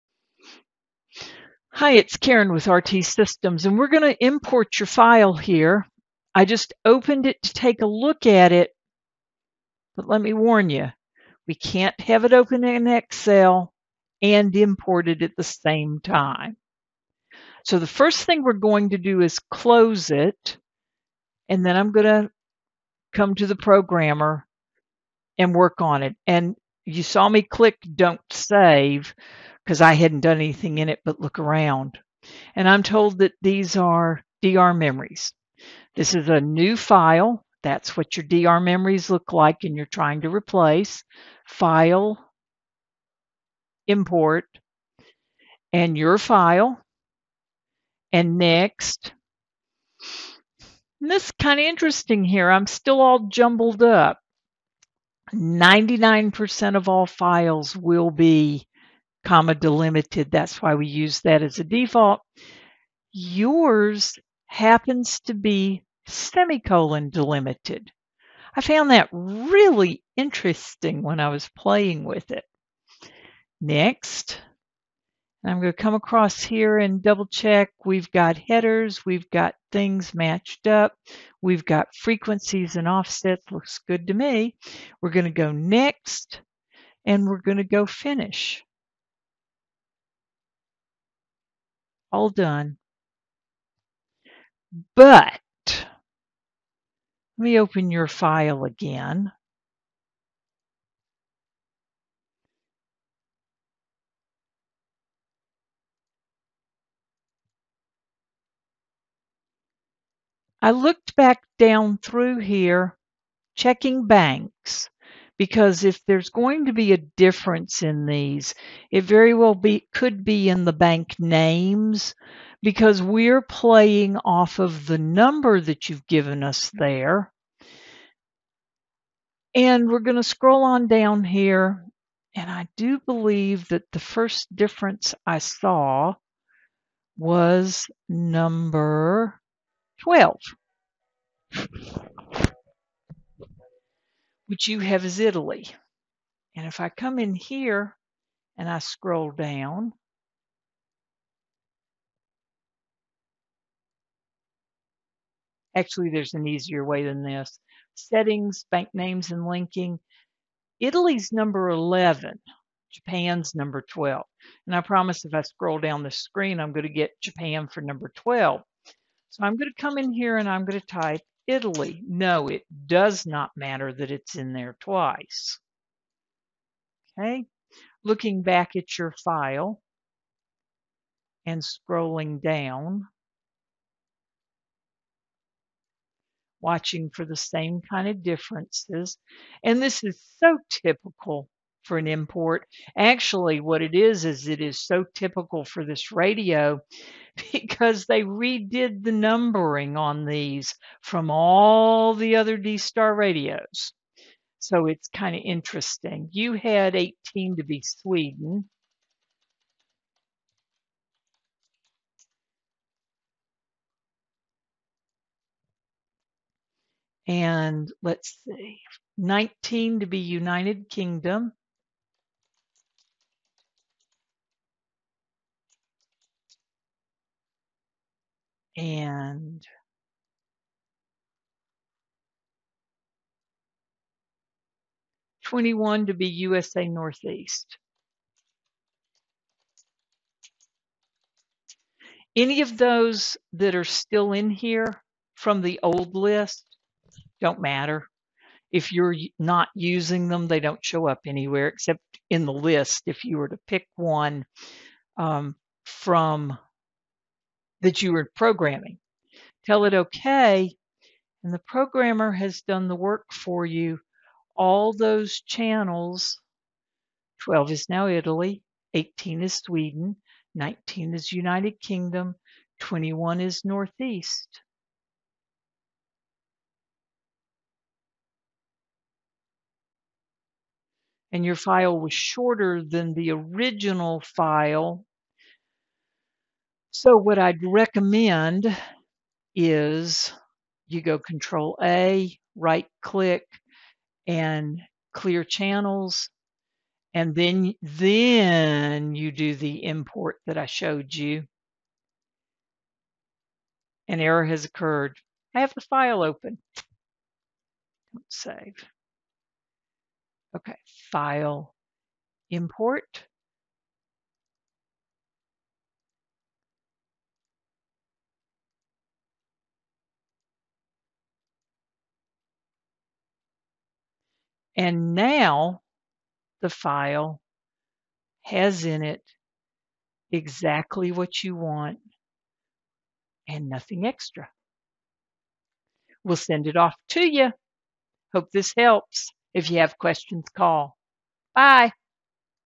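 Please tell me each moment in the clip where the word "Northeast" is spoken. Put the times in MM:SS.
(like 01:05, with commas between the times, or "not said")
03:56, 04:33.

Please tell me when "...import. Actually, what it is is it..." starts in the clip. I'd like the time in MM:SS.
03:12.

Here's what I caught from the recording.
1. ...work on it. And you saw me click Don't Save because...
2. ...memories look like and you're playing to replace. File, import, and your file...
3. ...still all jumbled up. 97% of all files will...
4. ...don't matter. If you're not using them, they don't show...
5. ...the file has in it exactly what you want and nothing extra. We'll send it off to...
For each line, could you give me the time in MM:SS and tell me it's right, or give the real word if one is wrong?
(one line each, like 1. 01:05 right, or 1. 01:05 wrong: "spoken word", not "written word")
1. 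00:25 right
2. 00:38 wrong: "trying", not "playing"
3. 00:52 wrong: "99", not "97"
4. 04:07 right
5. 05:26 right.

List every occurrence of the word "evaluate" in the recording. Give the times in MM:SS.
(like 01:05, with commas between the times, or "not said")
not said.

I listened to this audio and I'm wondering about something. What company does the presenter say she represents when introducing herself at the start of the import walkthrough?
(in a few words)
RT Systems.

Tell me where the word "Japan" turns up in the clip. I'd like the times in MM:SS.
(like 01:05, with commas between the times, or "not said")
02:42, 02:47.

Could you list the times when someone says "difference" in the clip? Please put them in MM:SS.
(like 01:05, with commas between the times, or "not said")
01:57, 02:14, 03:08.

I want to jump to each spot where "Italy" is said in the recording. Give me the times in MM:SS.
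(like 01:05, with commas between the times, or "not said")
02:25, 02:40, 02:51, 04:28.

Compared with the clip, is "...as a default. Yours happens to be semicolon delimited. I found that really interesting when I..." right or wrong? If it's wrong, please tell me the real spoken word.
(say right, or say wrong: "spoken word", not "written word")
right.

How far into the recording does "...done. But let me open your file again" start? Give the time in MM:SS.
01:32.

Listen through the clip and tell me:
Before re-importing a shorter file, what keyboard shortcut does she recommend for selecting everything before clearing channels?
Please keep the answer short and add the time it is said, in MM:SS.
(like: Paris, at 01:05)
Control A, at 04:51.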